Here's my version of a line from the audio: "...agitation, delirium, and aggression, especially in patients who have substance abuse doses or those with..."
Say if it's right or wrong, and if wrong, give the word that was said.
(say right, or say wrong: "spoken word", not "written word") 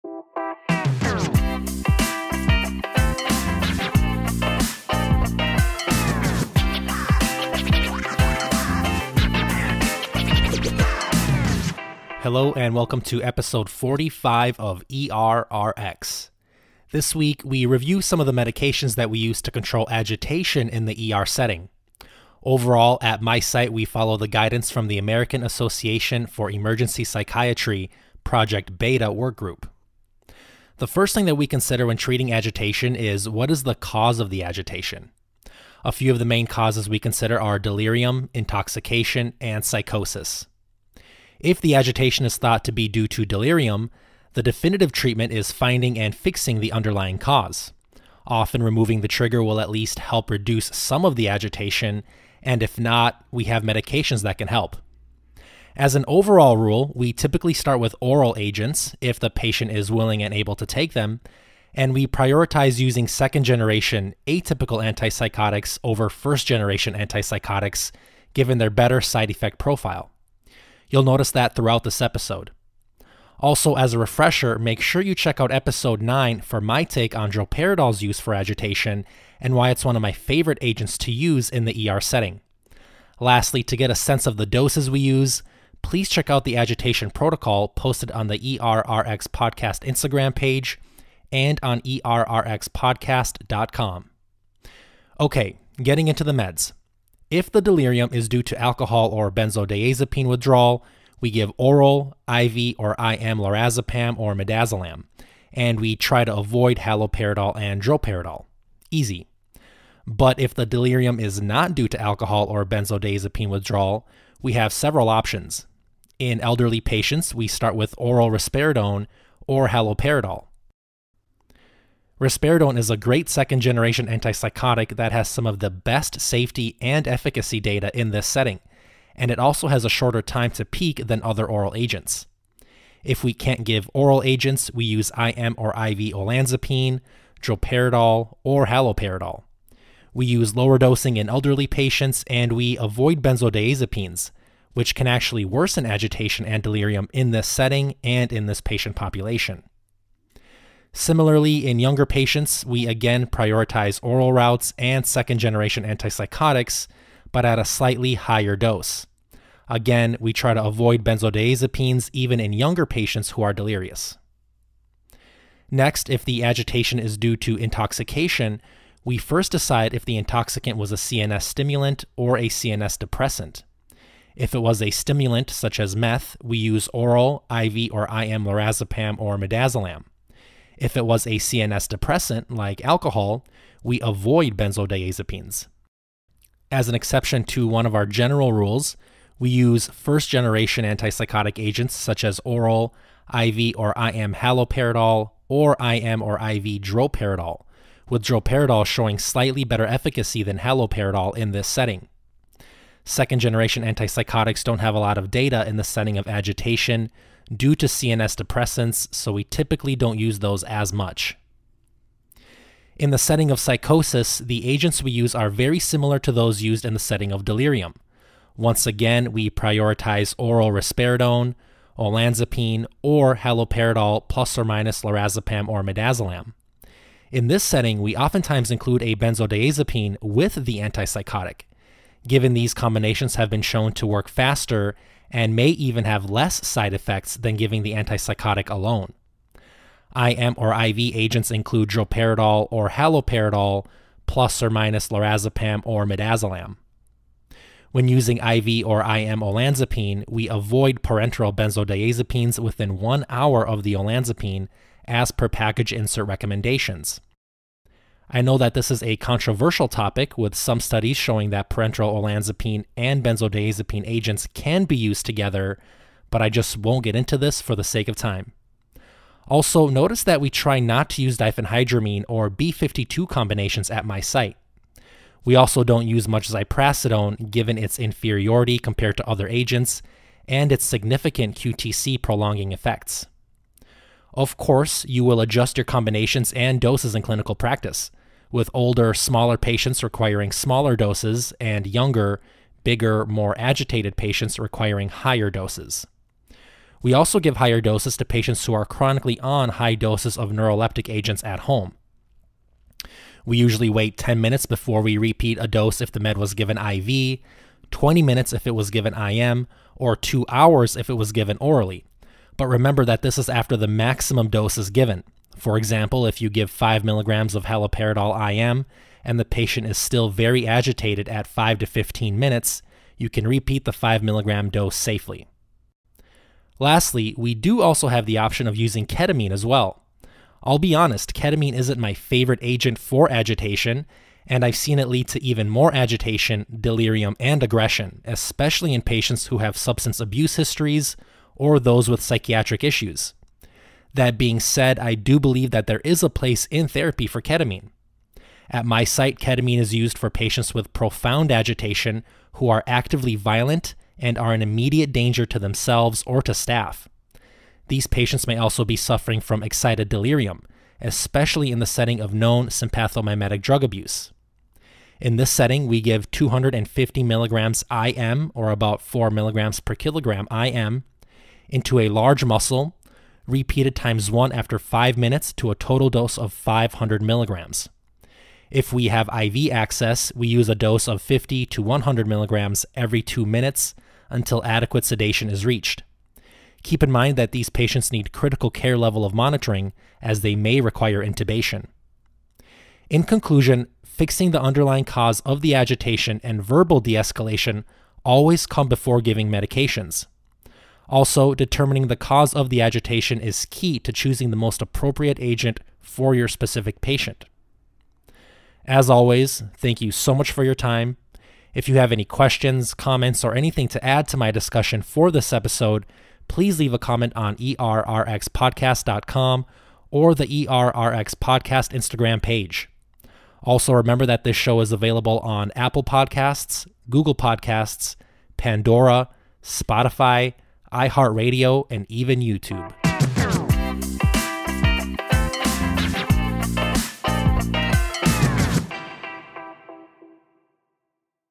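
wrong: "histories", not "doses".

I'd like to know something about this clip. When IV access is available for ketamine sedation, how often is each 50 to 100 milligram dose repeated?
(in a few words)
Every 2 minutes.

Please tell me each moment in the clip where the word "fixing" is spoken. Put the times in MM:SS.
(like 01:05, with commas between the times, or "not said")
00:46, 06:34.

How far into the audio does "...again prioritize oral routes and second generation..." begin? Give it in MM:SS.
02:32.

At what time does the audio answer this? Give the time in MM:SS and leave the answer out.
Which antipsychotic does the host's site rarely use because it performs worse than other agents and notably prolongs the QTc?
04:36.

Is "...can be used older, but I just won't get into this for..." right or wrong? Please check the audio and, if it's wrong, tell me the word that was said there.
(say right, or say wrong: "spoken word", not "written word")
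wrong: "together", not "older".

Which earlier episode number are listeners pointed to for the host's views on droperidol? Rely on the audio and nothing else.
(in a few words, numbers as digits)
9.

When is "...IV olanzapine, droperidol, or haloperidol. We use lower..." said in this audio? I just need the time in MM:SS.
02:15.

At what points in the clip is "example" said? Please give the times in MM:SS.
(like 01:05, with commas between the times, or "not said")
05:15.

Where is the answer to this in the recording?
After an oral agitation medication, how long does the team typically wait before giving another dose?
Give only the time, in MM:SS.
05:10.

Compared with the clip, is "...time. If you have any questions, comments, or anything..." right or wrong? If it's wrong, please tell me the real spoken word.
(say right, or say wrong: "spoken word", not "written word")
right.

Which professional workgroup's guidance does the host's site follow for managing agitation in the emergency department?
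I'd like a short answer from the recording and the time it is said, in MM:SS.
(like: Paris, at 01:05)
Project Beta Workgroup, at 00:28.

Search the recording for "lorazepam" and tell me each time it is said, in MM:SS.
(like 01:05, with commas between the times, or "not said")
01:43, 02:58, 03:45, 04:05.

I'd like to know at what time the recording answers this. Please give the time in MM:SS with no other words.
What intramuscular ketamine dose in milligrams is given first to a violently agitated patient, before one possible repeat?
06:06.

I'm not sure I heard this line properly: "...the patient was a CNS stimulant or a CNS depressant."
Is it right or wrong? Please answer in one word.
wrong.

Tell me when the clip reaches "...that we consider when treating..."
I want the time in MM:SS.
00:31.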